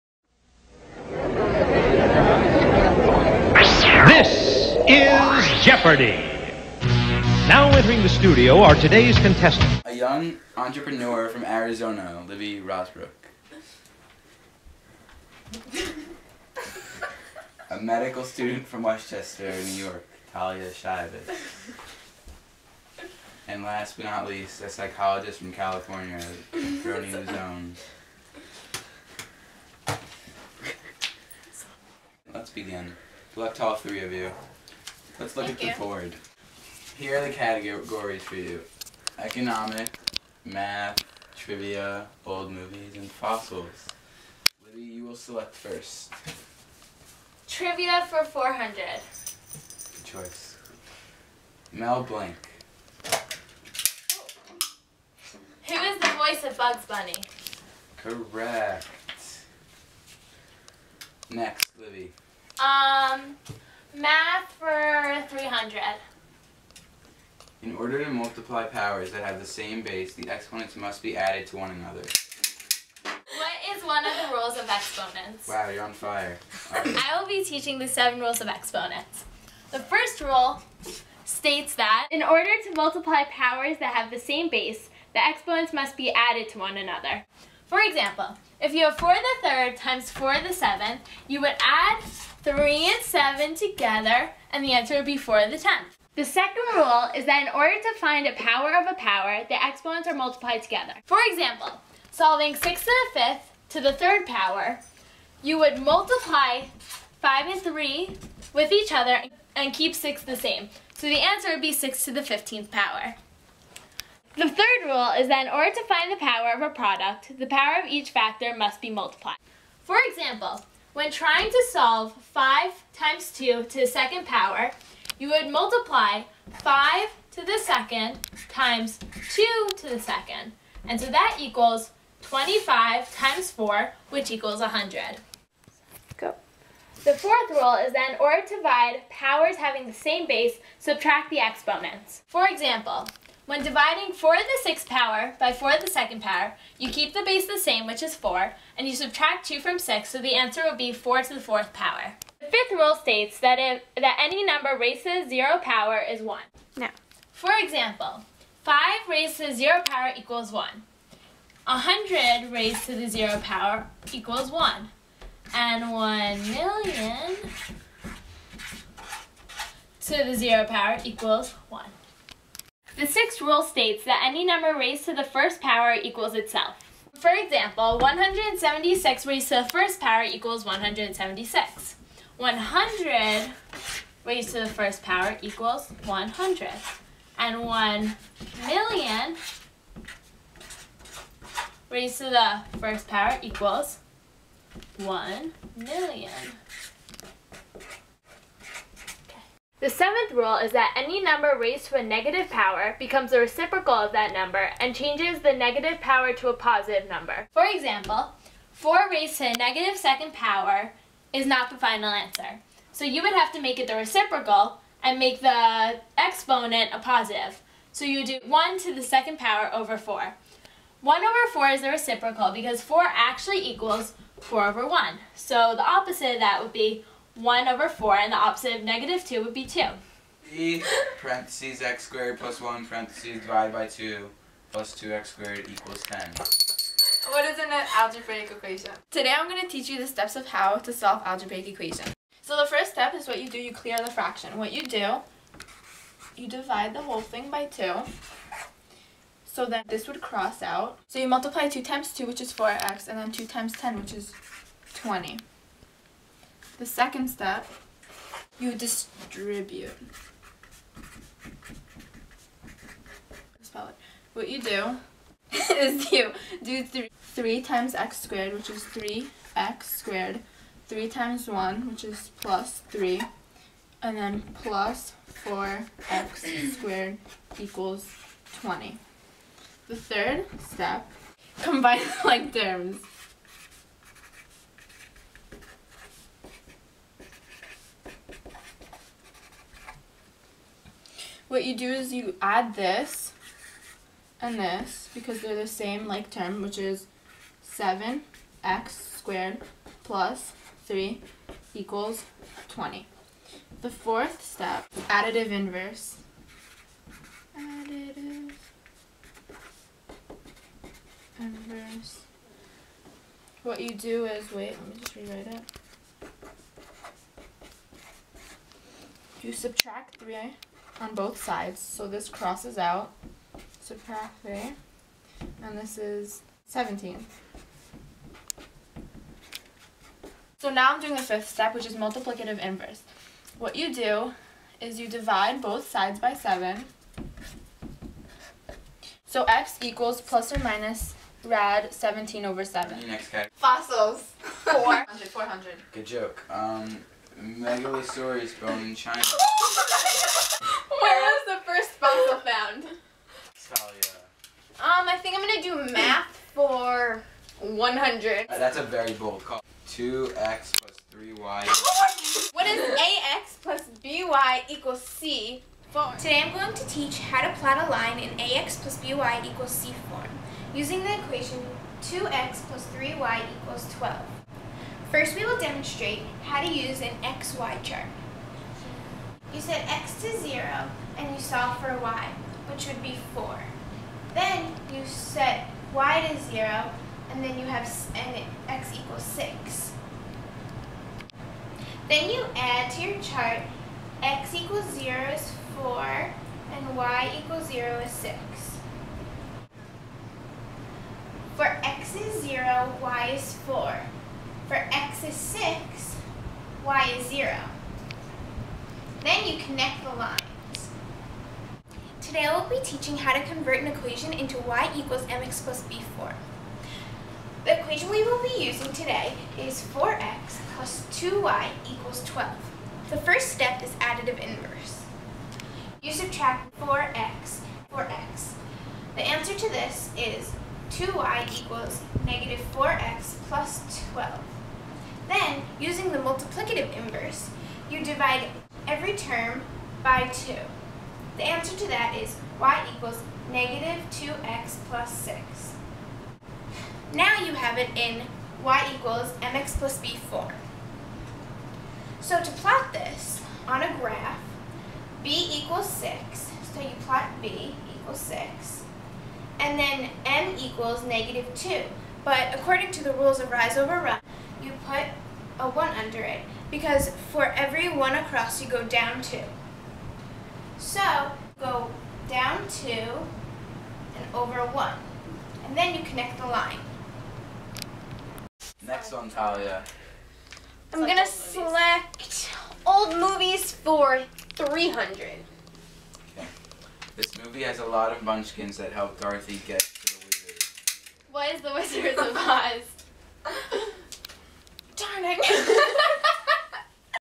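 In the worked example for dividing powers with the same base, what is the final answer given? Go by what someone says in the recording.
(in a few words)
4 to the 4th power.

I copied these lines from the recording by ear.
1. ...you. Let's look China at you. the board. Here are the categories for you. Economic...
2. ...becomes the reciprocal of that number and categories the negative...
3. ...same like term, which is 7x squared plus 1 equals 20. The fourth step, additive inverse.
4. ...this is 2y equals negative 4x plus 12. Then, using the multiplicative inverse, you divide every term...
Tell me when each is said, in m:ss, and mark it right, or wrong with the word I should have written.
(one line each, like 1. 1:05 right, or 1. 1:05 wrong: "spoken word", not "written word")
1. 0:34 wrong: "Thank", not "China"
2. 3:22 wrong: "changes", not "categories"
3. 4:55 wrong: "3", not "1"
4. 7:09 right.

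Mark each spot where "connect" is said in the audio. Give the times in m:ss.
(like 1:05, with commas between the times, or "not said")
6:49, 7:56.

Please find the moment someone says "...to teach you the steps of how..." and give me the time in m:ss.
3:59.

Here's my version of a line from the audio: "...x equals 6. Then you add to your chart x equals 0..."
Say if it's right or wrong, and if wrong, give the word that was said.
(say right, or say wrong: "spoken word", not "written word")
right.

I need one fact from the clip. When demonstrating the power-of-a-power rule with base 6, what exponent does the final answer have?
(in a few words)
15.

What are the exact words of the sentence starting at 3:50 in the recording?
E parentheses x squared plus 1 parentheses divided by 2 plus 2x squared equals 10.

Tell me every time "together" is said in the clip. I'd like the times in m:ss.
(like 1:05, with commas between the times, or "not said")
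1:33, 1:40.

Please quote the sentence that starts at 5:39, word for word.
So x equals plus or minus rad 17 over 7.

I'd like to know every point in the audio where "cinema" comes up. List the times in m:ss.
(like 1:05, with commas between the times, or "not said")
not said.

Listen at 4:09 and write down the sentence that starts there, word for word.
So then this would cross out.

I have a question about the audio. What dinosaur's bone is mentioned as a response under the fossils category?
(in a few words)
Megalosaurus.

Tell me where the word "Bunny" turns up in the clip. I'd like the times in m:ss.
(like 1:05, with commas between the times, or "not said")
0:56.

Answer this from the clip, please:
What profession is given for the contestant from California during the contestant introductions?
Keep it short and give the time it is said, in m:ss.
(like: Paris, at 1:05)
Psychologist, at 0:24.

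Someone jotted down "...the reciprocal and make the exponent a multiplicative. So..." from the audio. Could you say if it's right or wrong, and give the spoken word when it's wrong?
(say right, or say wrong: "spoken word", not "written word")
wrong: "positive", not "multiplicative".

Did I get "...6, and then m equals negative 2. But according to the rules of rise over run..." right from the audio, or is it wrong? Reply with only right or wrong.
right.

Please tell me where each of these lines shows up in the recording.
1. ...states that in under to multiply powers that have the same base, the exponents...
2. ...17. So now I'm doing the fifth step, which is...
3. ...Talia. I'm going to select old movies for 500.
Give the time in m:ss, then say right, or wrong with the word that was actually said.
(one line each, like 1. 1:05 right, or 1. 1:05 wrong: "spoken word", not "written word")
1. 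1:21 wrong: "order", not "under"
2. 5:26 right
3. 7:59 wrong: "300", not "500".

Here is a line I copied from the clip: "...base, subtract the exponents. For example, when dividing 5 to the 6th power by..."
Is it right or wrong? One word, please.
wrong.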